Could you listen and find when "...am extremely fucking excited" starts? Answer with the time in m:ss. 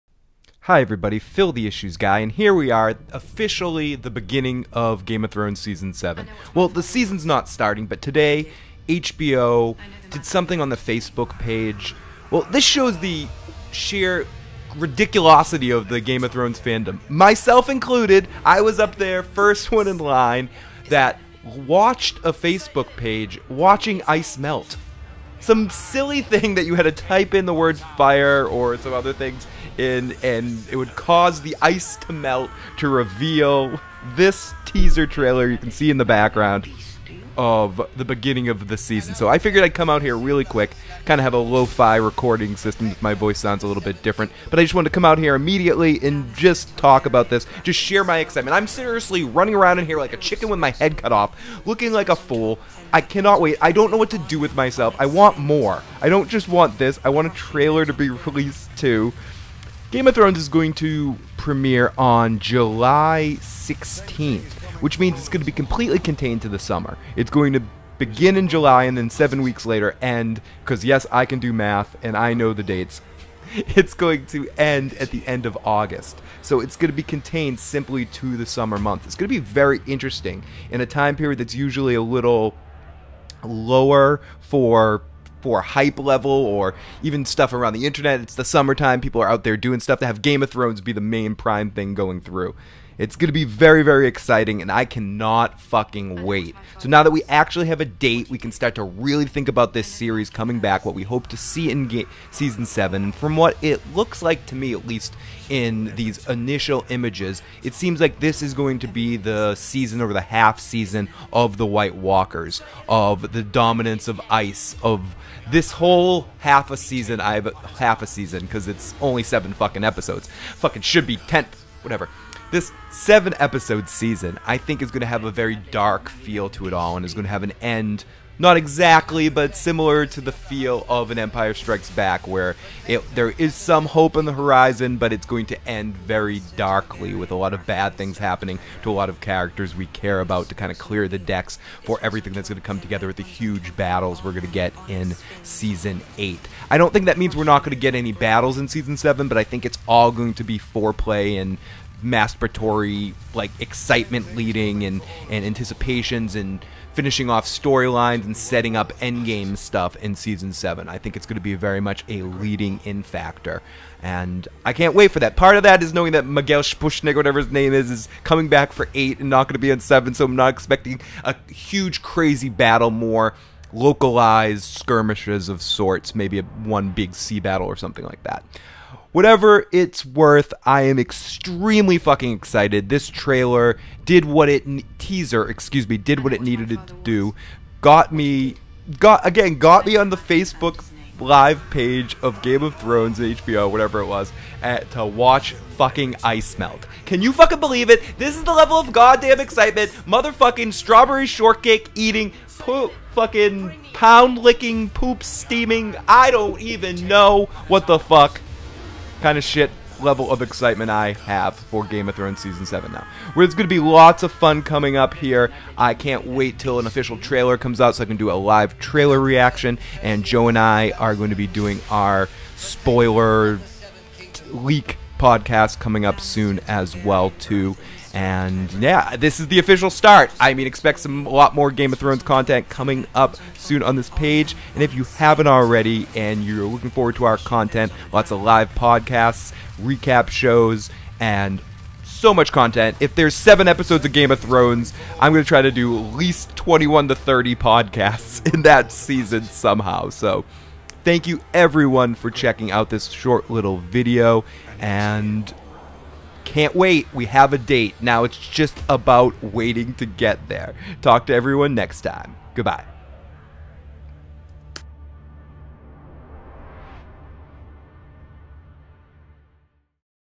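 3:00.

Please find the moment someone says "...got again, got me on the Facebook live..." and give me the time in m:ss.
3:08.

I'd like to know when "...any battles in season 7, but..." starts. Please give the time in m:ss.
2:27.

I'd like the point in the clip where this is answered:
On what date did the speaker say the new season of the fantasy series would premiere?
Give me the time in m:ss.
1:02.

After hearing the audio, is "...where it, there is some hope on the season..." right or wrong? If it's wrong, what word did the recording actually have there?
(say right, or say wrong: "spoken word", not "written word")
wrong: "horizon", not "season".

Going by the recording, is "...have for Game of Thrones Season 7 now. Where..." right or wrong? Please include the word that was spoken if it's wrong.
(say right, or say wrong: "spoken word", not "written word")
right.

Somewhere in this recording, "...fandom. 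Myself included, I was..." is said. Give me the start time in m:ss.
0:16.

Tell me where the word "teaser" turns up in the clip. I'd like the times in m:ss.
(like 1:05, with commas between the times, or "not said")
0:34, 3:04.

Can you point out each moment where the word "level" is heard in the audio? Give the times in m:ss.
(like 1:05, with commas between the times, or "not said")
1:25, 3:18, 3:30.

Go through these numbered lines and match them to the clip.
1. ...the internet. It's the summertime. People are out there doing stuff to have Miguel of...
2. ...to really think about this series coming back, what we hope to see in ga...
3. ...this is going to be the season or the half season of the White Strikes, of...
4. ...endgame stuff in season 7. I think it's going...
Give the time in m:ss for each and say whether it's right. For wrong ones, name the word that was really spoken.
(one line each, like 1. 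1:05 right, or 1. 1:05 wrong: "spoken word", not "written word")
1. 1:27 wrong: "Game", not "Miguel"
2. 1:38 right
3. 1:48 wrong: "Walkers", not "Strikes"
4. 2:38 right.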